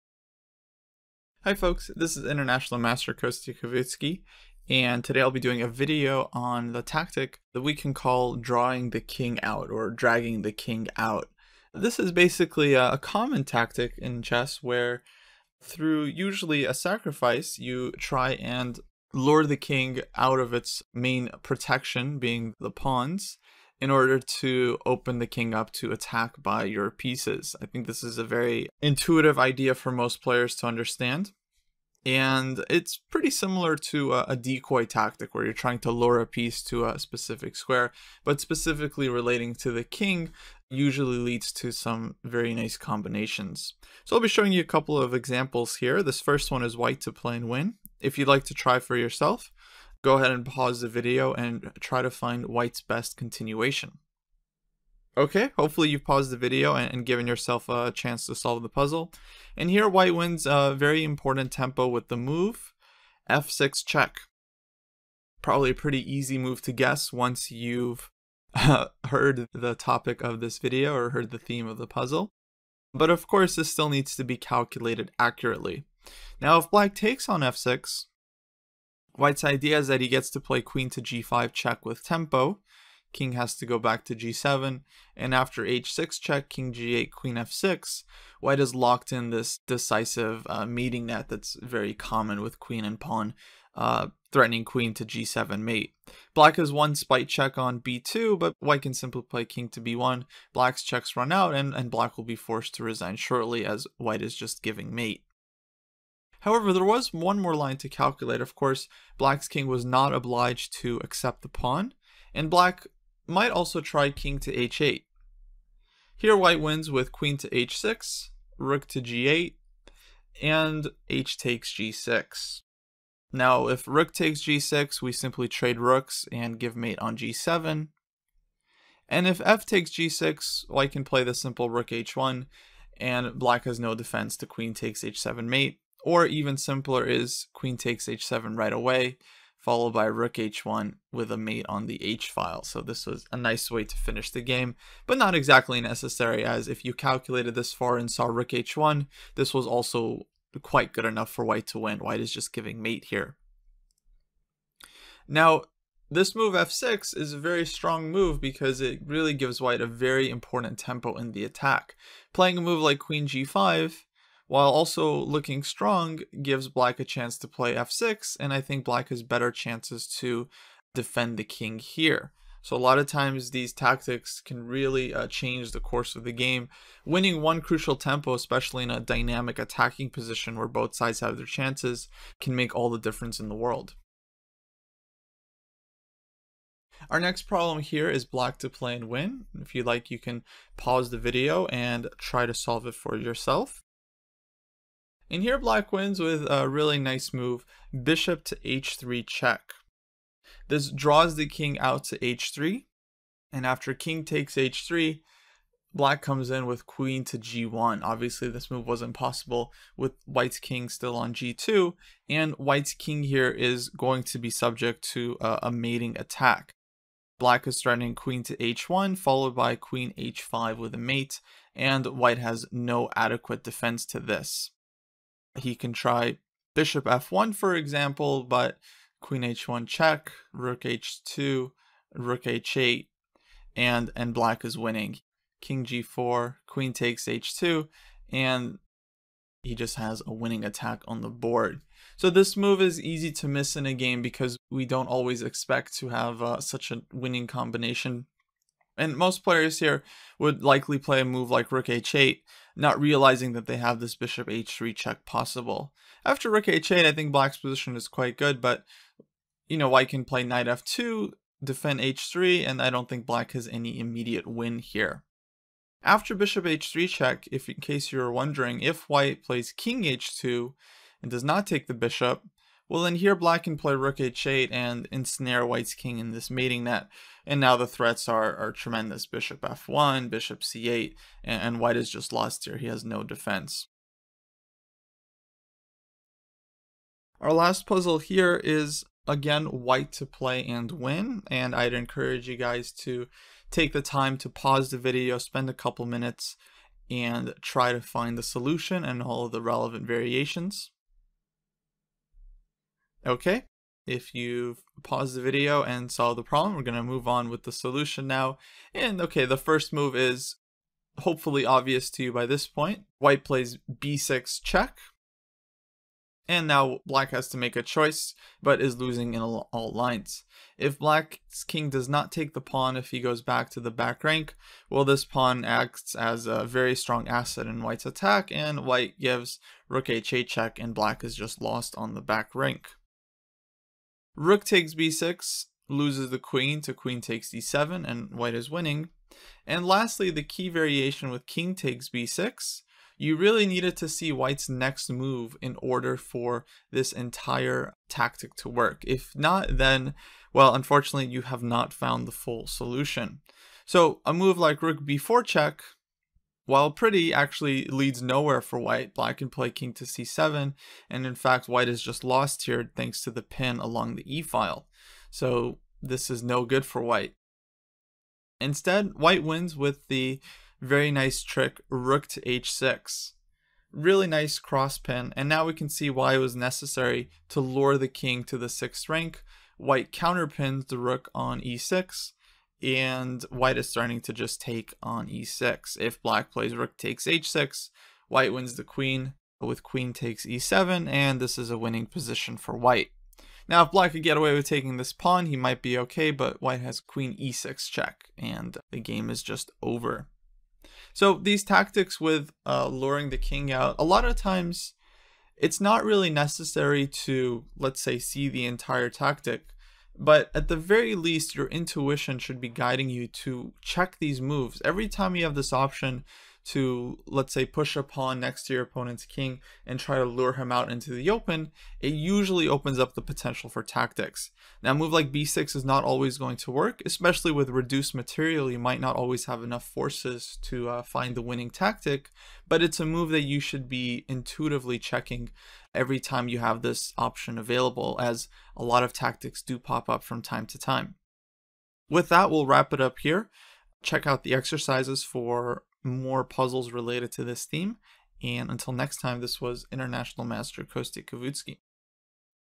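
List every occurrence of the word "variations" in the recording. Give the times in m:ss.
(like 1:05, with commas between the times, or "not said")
5:00, 5:40.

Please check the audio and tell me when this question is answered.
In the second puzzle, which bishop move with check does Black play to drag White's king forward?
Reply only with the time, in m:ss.
3:18.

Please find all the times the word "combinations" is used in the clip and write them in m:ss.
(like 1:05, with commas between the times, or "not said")
0:42, 4:07.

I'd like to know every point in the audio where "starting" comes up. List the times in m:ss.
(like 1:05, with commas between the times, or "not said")
6:23.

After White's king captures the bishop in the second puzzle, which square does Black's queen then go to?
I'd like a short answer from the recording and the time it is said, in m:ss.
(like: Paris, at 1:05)
g1, at 3:26.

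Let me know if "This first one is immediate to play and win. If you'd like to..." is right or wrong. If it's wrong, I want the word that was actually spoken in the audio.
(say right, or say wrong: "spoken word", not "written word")
wrong: "white", not "immediate".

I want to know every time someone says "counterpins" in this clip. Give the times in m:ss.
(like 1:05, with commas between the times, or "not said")
6:20.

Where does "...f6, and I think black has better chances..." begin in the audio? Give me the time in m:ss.
2:47.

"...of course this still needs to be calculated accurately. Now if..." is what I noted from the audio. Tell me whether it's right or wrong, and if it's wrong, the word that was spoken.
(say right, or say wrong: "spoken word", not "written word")
right.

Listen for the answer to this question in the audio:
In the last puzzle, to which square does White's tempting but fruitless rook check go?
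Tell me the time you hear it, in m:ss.
5:54.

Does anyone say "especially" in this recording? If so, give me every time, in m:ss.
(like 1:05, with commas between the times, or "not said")
2:58, 7:07.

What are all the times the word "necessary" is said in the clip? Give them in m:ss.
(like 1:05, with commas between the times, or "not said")
2:25, 6:16, 6:46.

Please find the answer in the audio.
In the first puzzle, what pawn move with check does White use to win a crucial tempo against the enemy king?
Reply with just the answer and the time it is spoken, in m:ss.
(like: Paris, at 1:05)
f6, at 1:02.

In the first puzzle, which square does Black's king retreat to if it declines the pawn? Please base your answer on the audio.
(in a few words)
h8.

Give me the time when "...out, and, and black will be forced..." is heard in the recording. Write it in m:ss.
1:41.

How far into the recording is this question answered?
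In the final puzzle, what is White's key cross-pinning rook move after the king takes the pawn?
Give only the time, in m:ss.
6:11.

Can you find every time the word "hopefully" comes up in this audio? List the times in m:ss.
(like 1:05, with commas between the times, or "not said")
0:55, 5:11.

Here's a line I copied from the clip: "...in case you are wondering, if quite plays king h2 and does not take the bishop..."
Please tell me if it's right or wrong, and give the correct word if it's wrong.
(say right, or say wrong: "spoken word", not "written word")
wrong: "white", not "quite".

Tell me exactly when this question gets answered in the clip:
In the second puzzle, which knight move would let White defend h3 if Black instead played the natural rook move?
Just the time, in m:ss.
4:20.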